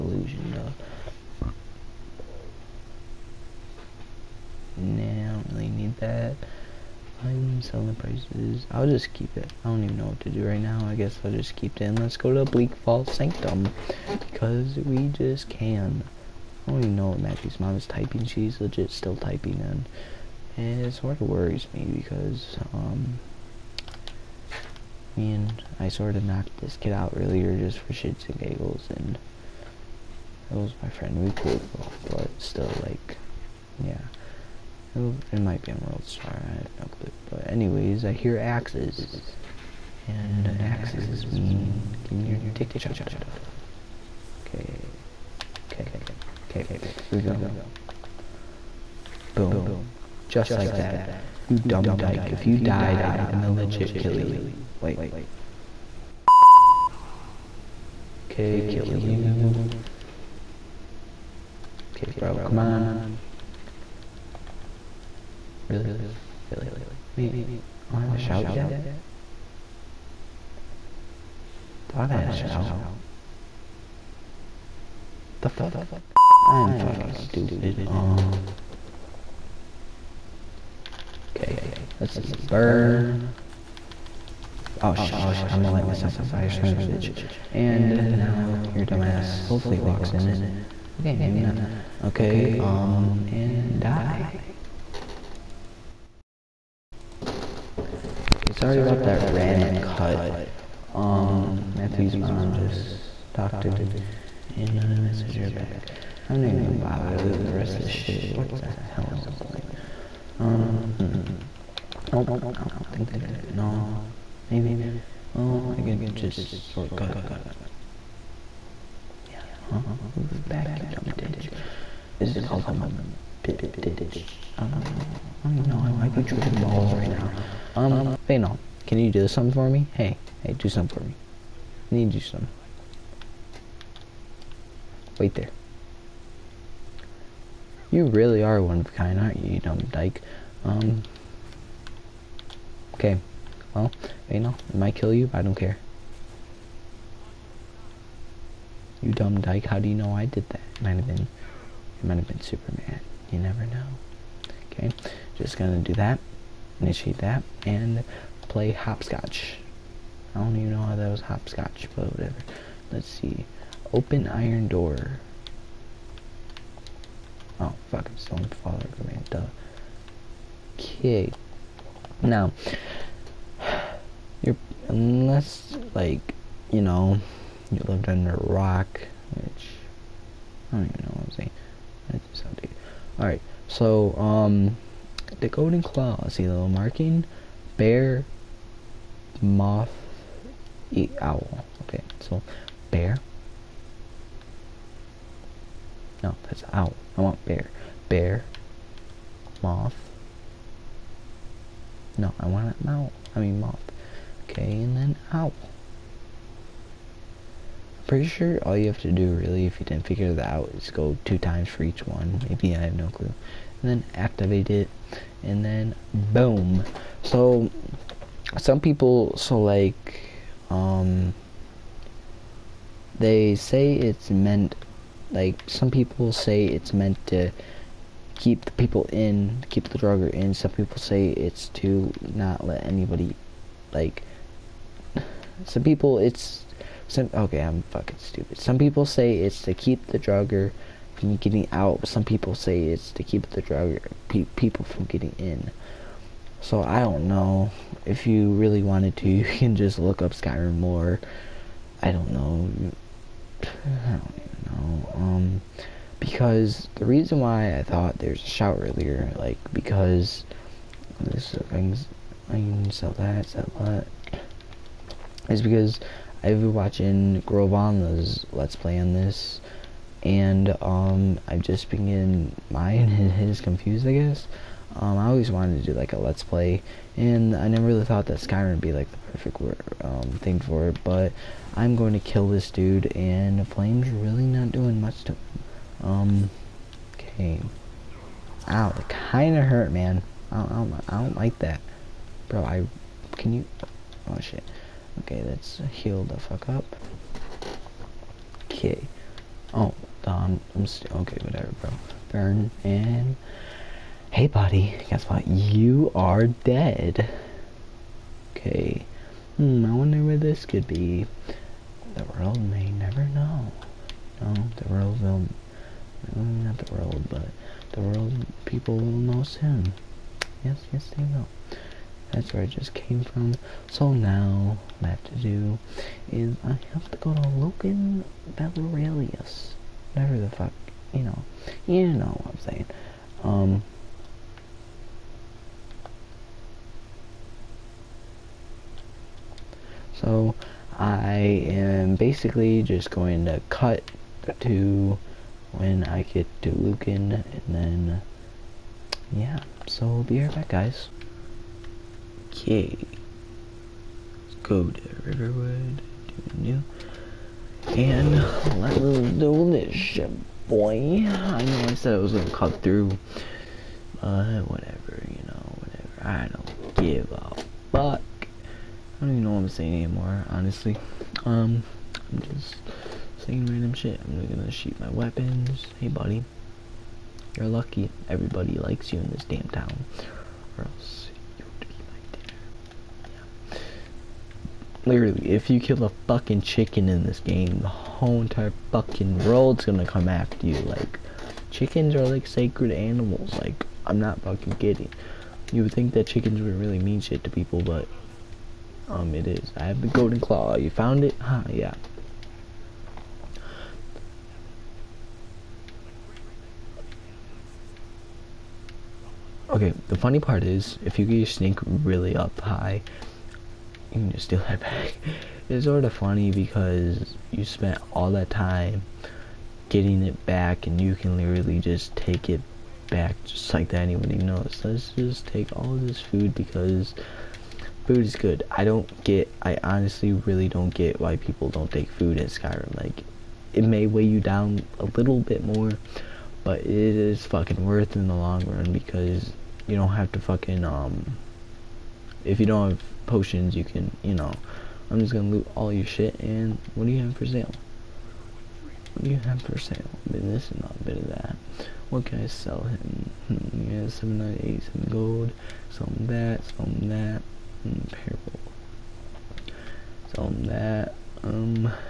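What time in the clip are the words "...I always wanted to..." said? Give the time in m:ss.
4:35.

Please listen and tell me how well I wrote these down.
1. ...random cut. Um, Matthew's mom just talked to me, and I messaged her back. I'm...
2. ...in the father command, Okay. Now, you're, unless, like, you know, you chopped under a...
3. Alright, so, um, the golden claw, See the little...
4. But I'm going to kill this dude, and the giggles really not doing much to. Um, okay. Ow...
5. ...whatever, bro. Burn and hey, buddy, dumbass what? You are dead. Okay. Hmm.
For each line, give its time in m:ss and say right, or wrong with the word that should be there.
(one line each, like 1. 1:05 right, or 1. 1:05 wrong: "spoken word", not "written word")
1. 1:39 right
2. 2:48 wrong: "lived", not "chopped"
3. 3:03 right
4. 4:41 wrong: "flames", not "giggles"
5. 5:01 wrong: "guess", not "dumbass".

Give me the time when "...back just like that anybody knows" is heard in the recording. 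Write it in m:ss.
7:03.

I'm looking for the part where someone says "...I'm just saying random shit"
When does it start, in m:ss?
6:12.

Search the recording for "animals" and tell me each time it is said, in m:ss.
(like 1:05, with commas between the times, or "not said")
6:32.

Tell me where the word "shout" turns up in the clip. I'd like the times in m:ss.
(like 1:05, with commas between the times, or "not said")
1:08, 1:12.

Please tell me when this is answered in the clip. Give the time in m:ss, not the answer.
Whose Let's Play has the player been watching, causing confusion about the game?
4:27.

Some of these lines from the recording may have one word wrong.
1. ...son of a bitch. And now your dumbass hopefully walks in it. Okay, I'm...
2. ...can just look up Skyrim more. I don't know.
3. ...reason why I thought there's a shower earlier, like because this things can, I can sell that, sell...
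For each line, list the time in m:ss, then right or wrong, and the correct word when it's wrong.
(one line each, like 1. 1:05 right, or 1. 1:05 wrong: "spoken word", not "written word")
1. 1:26 right
2. 4:09 right
3. 4:17 right.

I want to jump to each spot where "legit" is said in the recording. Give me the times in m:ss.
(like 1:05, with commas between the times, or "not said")
0:18, 0:53.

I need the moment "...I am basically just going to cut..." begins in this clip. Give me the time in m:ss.
5:40.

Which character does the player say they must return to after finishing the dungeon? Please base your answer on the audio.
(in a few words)
Lucan Valerius.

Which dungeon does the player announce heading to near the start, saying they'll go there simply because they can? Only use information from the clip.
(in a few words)
Bleak Falls Sanctum.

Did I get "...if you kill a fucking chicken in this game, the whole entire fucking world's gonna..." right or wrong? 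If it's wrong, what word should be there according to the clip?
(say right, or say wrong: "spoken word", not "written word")
right.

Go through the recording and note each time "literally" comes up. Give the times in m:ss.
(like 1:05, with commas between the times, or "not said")
6:25, 7:01.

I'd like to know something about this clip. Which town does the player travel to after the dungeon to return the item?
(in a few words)
Riverwood.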